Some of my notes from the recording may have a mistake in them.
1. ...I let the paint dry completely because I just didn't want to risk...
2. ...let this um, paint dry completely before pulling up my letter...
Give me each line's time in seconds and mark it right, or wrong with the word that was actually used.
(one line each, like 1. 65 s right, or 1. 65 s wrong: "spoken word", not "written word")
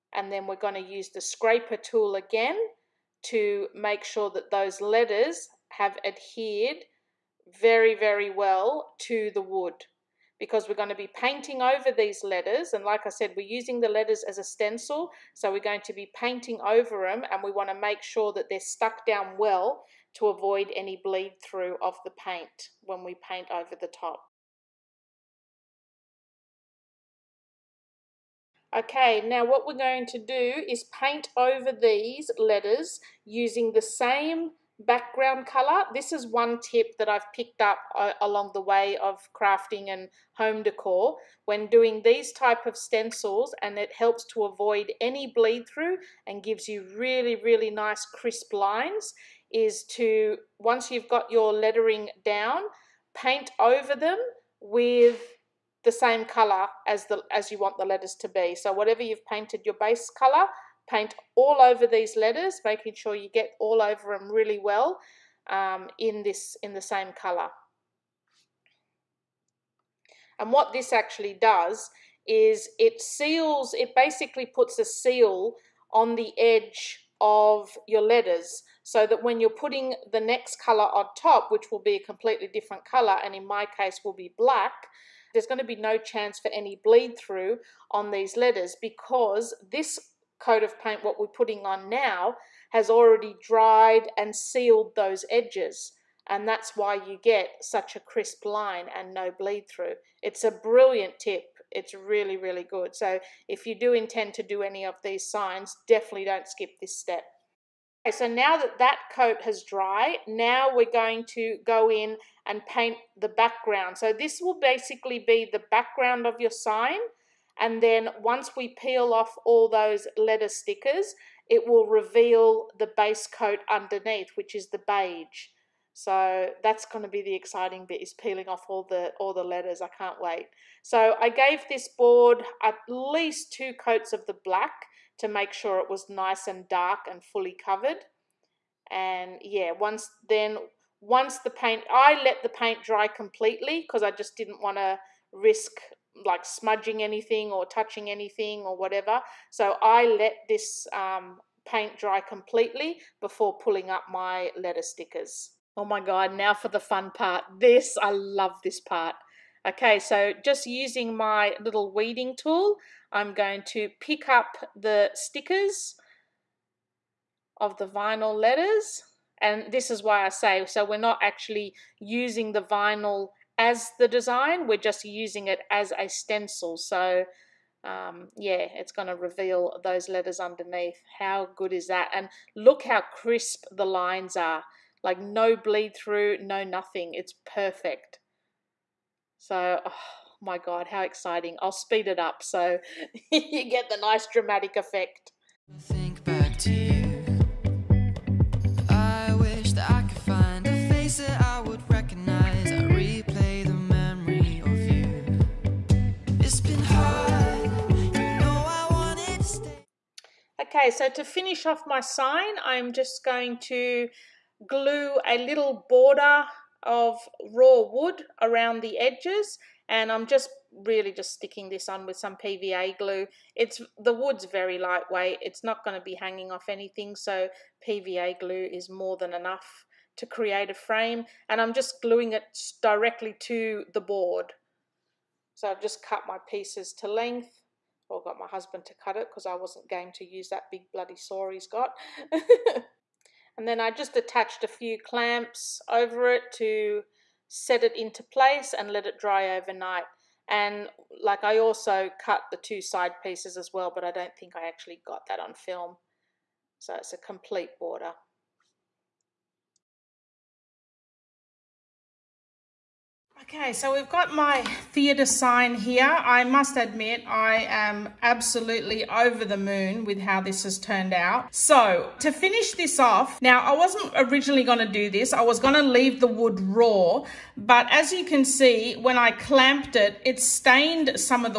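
1. 141 s right
2. 150 s right.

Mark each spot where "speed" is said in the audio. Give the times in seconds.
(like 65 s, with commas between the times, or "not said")
191 s.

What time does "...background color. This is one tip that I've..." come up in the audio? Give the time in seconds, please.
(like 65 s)
34 s.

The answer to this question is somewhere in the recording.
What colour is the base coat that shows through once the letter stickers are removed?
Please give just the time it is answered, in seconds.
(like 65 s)
124 s.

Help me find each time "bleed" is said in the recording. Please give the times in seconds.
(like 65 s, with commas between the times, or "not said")
21 s, 45 s, 86 s, 99 s, 185 s.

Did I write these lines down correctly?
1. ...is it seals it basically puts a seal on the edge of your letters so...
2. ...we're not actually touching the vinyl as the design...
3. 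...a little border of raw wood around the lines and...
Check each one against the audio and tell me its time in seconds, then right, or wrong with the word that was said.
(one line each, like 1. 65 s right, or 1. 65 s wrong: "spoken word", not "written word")
1. 72 s right
2. 170 s wrong: "using", not "touching"
3. 215 s wrong: "edges", not "lines".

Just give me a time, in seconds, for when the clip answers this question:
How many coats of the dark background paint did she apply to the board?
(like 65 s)
133 s.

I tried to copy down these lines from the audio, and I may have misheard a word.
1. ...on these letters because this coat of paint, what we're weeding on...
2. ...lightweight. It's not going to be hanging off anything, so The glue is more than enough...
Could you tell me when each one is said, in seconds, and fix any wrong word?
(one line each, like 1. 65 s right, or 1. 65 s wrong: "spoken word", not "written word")
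1. 87 s wrong: "putting", not "weeding"
2. 224 s wrong: "PVA", not "The".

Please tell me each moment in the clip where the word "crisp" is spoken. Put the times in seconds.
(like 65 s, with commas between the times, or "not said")
48 s, 97 s, 183 s.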